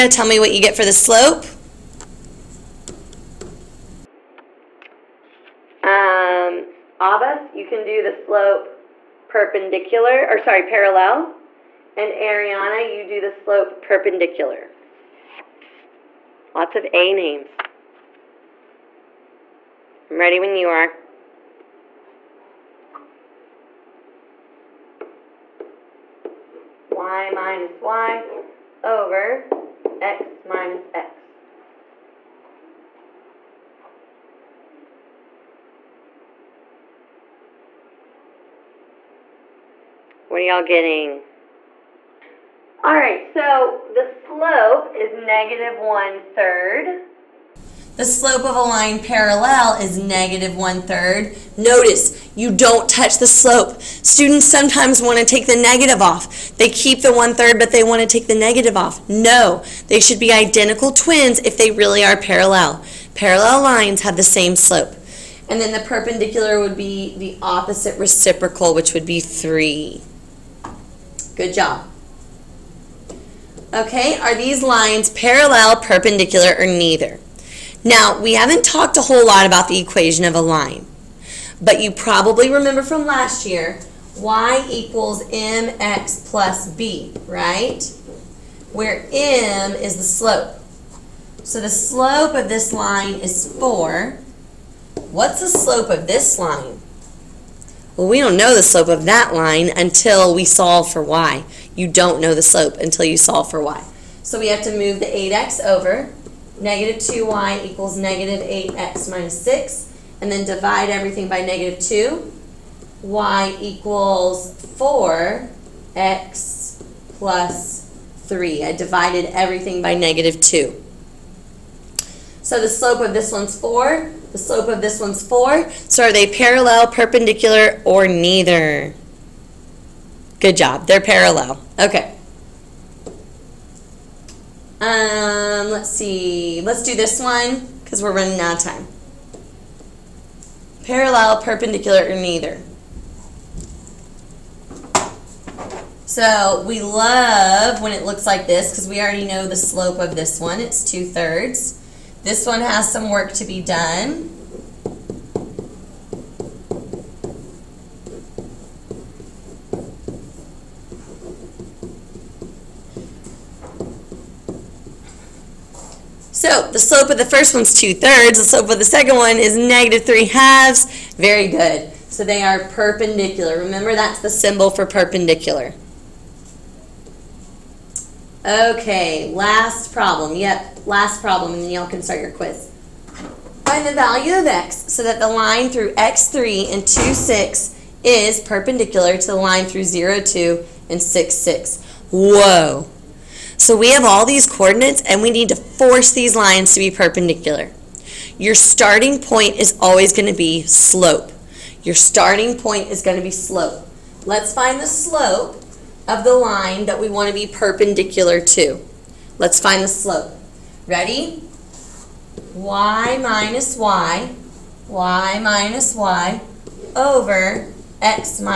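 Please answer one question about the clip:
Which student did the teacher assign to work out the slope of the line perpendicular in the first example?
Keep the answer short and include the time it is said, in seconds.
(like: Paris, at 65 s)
Ariana, at 12 s.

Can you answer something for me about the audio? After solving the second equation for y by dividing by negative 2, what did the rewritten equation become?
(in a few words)
y = 4x + 3.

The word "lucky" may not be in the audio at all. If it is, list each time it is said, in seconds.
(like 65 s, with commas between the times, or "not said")
not said.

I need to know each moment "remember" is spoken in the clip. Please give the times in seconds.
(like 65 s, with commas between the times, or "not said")
82 s, 173 s.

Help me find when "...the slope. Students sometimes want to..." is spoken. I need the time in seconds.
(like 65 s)
53 s.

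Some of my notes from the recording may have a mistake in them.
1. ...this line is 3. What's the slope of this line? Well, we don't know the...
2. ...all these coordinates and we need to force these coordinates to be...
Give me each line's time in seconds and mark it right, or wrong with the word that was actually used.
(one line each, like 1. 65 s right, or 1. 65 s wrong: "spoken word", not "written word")
1. 92 s wrong: "4", not "3"
2. 194 s wrong: "lines", not "coordinates".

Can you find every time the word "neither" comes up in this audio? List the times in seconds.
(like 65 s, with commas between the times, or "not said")
76 s, 128 s, 142 s.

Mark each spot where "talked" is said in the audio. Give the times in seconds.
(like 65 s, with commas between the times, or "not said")
78 s.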